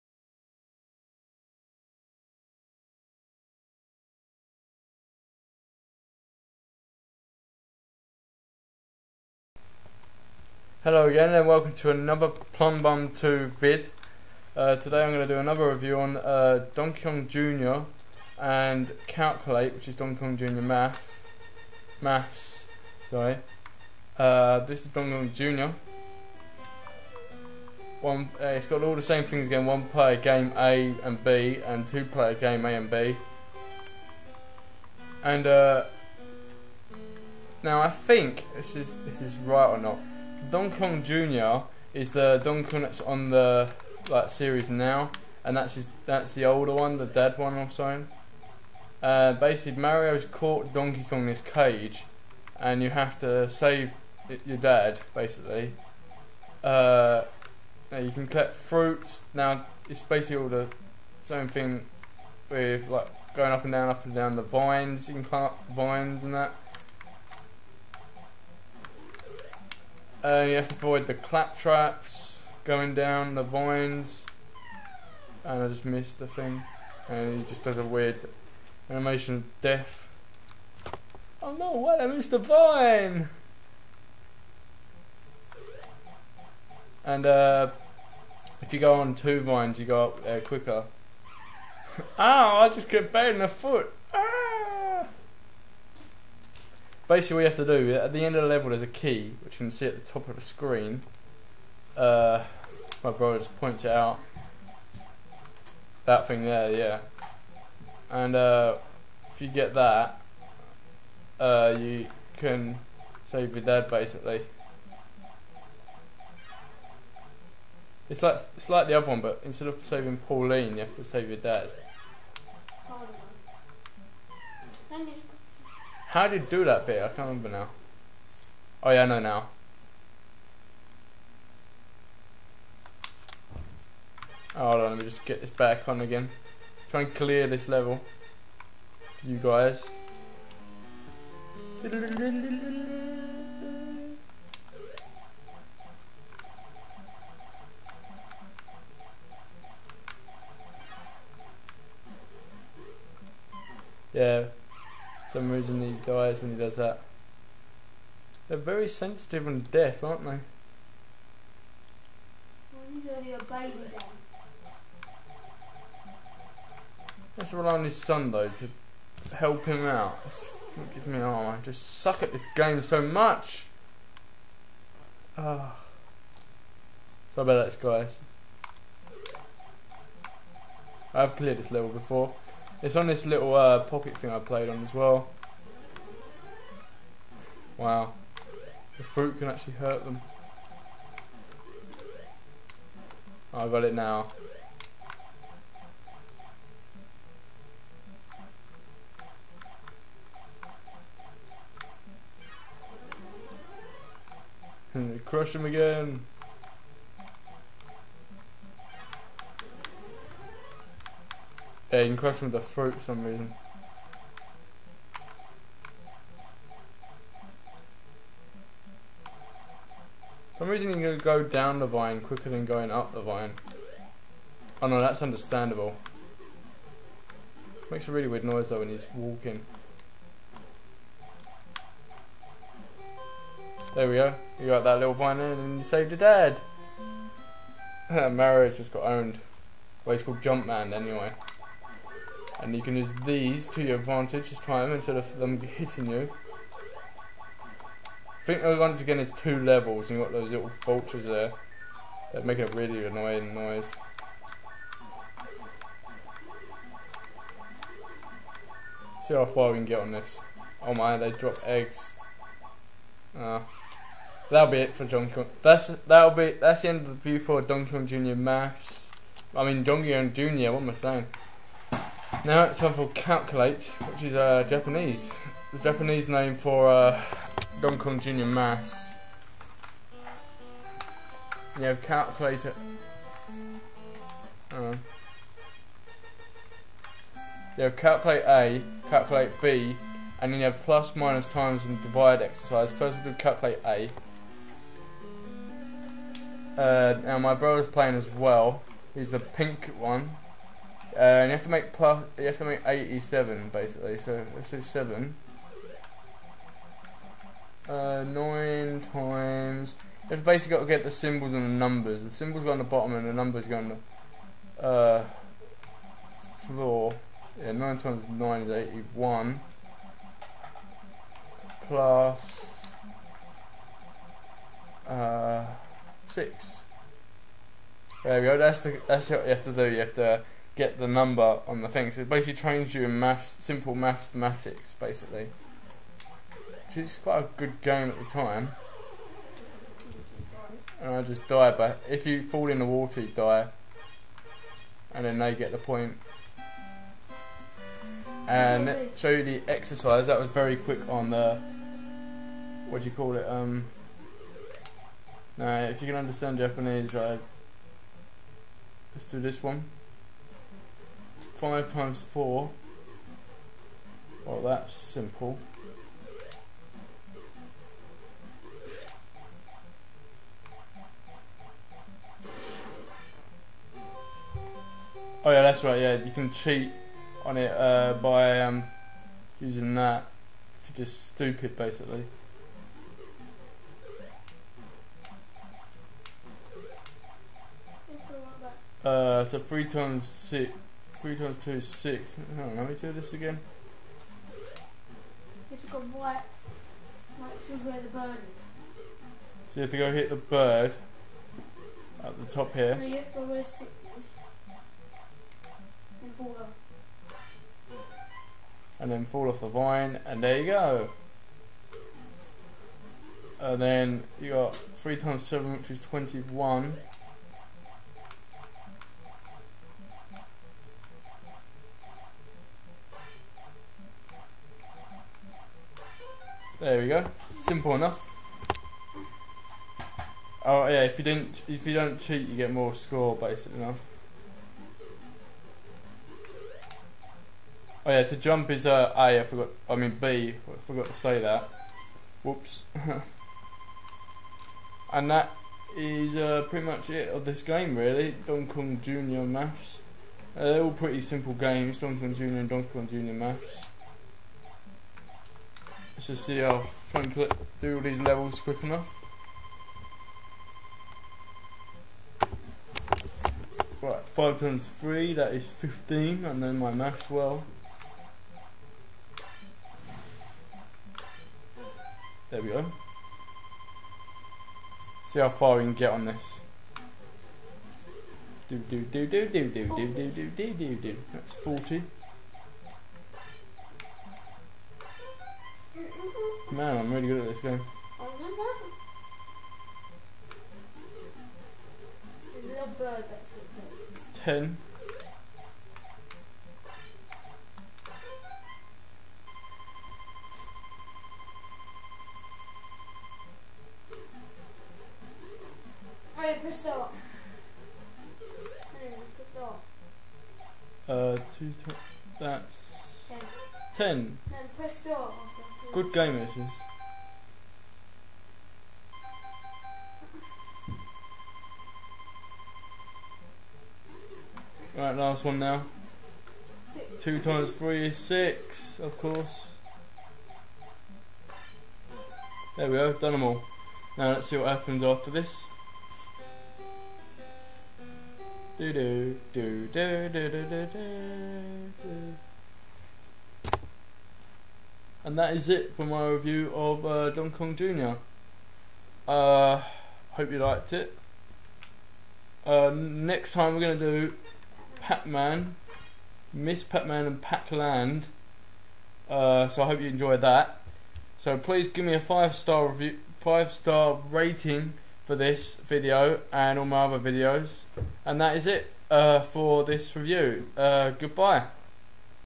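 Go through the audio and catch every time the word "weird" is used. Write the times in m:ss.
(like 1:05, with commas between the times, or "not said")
1:17, 3:48.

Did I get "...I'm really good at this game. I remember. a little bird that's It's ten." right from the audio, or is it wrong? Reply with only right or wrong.
right.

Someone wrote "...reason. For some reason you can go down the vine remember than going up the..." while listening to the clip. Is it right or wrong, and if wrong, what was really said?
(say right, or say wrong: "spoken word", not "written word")
wrong: "quicker", not "remember".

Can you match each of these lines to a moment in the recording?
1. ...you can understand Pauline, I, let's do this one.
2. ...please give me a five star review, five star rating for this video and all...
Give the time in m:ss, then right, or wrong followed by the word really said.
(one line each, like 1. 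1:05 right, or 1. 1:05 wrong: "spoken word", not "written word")
1. 5:56 wrong: "Japanese", not "Pauline"
2. 9:21 right.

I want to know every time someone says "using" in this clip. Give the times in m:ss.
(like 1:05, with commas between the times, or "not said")
6:19.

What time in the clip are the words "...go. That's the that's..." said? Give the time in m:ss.
5:28.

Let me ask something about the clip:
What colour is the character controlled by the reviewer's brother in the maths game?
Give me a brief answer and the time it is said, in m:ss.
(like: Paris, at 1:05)
Pink, at 4:59.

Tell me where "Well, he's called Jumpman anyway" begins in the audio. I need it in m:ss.
4:00.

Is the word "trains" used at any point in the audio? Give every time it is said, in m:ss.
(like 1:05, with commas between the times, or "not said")
5:32.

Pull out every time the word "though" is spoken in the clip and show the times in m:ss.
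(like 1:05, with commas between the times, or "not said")
2:48, 3:48.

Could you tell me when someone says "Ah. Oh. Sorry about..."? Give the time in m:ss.
2:55.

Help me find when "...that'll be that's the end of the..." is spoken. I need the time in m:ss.
4:25.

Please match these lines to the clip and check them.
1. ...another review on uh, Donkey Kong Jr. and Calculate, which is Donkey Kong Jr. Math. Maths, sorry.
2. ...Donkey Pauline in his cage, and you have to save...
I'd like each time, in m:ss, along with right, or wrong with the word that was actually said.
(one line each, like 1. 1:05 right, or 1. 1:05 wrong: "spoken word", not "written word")
1. 0:15 right
2. 0:50 wrong: "Kong", not "Pauline".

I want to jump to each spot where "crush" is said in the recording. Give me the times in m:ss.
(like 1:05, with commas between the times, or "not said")
3:25, 3:32.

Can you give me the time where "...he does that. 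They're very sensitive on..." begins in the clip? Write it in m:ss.
2:36.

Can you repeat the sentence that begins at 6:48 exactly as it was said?
And then fall off the vine, and there you go.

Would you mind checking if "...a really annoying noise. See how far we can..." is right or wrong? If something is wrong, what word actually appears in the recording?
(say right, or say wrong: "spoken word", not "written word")
right.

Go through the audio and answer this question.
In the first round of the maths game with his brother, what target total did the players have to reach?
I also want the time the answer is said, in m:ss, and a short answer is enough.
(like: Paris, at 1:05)
87, at 5:02.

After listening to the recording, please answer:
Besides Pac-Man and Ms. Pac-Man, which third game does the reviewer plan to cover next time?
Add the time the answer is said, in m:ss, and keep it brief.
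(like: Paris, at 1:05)
Pac-Land, at 9:17.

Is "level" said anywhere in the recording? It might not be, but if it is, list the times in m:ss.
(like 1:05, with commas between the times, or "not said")
1:38, 2:17, 3:01, 4:09, 7:38.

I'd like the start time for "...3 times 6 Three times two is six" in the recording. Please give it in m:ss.
6:29.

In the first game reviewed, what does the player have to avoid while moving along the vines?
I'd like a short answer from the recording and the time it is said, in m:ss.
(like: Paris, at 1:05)
Clap traps, at 1:11.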